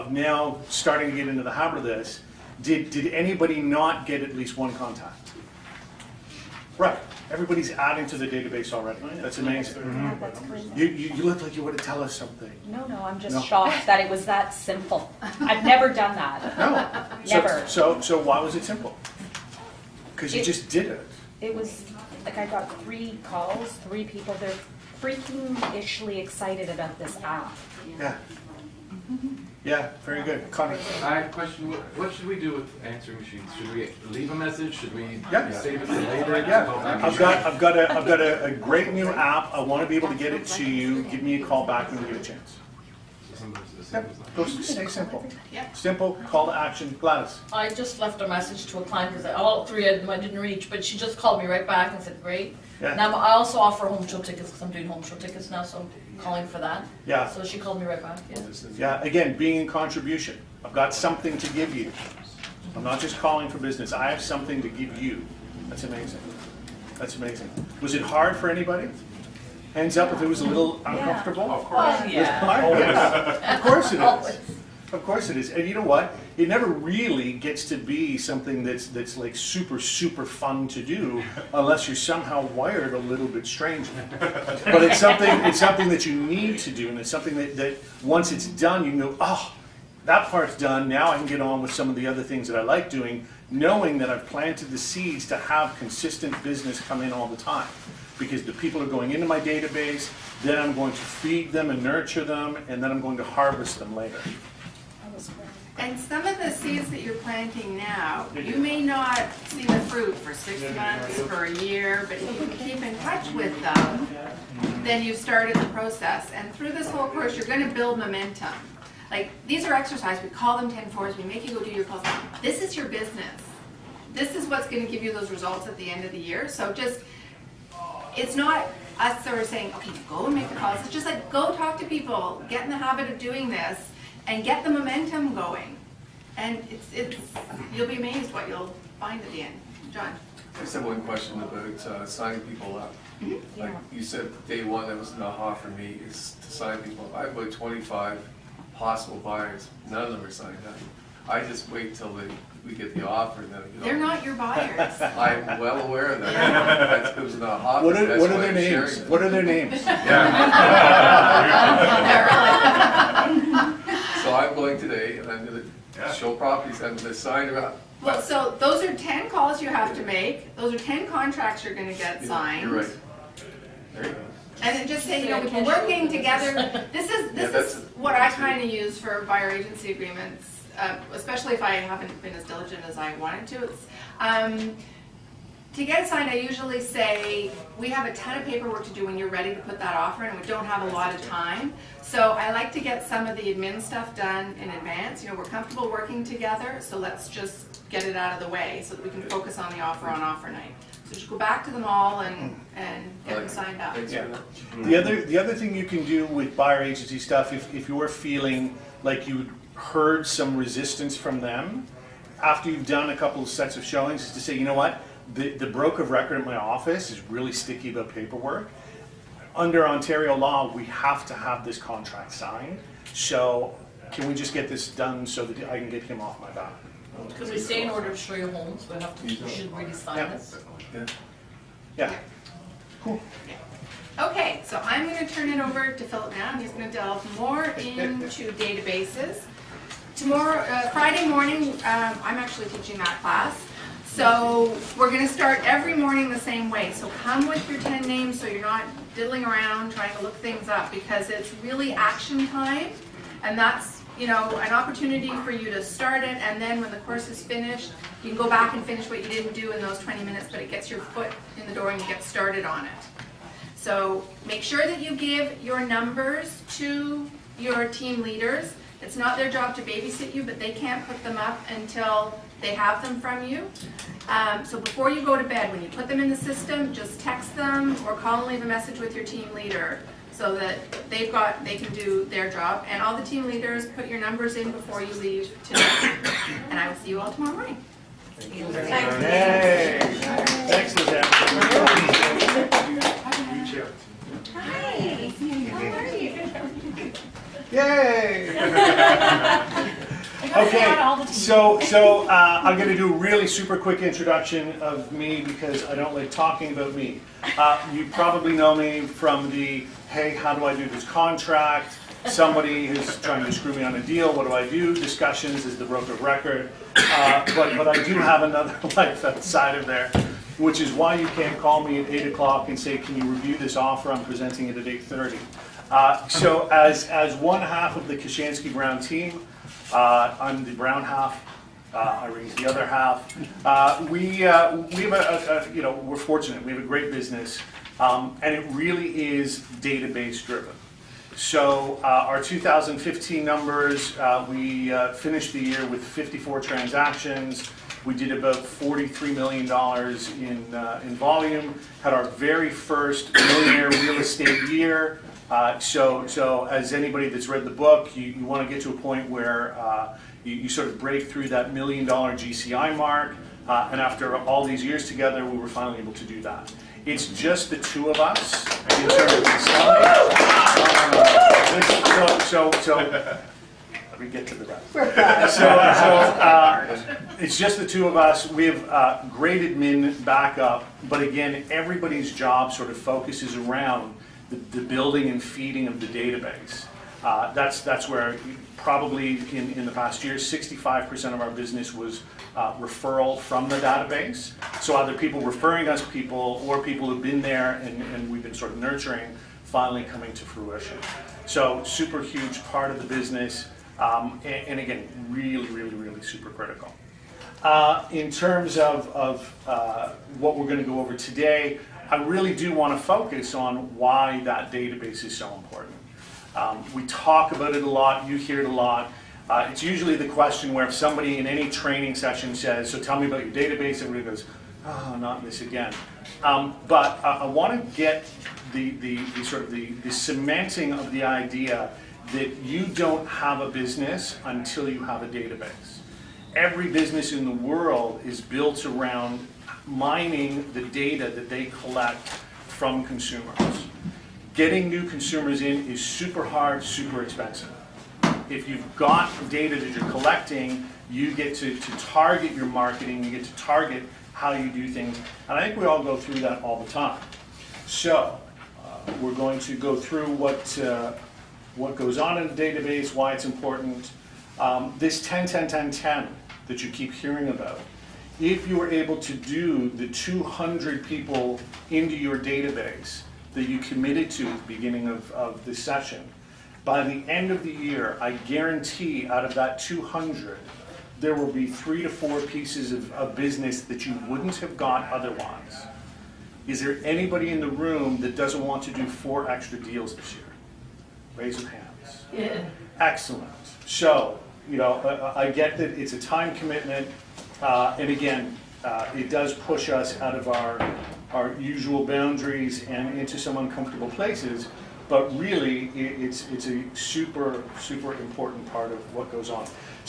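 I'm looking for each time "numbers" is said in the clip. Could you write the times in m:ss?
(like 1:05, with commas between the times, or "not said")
4:25, 4:44, 5:43.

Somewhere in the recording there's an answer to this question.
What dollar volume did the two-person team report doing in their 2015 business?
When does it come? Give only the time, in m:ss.
5:48.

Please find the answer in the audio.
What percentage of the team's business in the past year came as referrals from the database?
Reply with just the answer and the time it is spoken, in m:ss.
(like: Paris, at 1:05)
65%, at 6:30.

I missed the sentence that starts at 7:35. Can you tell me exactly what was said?
And I think we all go through that all the time.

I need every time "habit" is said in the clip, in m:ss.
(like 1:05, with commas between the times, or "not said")
0:01, 2:12.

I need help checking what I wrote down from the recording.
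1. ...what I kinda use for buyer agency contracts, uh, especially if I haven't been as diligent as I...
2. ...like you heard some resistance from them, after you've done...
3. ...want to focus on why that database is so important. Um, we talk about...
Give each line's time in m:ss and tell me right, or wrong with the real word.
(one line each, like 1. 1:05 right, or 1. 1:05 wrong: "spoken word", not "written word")
1. 2:57 wrong: "agreements", not "contracts"
2. 3:29 right
3. 6:52 right.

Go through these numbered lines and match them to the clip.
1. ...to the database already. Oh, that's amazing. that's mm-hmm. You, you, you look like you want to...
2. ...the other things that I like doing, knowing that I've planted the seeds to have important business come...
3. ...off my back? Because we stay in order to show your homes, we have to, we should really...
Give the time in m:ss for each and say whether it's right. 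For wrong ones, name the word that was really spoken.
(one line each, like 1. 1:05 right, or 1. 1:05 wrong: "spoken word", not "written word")
1. 0:08 right
2. 1:31 wrong: "consistent", not "important"
3. 3:46 right.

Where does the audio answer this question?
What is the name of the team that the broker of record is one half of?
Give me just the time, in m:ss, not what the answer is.
5:28.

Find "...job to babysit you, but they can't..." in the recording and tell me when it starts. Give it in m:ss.
4:29.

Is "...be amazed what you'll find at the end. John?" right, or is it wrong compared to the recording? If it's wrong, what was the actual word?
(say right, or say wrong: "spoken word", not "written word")
right.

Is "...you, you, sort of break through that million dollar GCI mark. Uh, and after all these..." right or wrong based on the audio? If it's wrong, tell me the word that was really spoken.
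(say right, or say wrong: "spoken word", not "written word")
right.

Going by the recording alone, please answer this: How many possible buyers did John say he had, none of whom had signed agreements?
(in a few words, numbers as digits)
25.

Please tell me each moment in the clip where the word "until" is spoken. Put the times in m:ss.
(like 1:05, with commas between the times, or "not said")
4:31, 7:14.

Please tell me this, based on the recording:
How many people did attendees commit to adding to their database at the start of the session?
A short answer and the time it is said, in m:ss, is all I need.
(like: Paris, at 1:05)
200, at 7:50.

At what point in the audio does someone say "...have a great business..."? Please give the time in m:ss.
5:36.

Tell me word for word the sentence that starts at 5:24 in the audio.
I'm presenting it at eight thirty.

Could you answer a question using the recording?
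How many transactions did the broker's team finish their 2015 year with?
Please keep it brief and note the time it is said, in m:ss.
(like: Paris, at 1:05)
54, at 5:46.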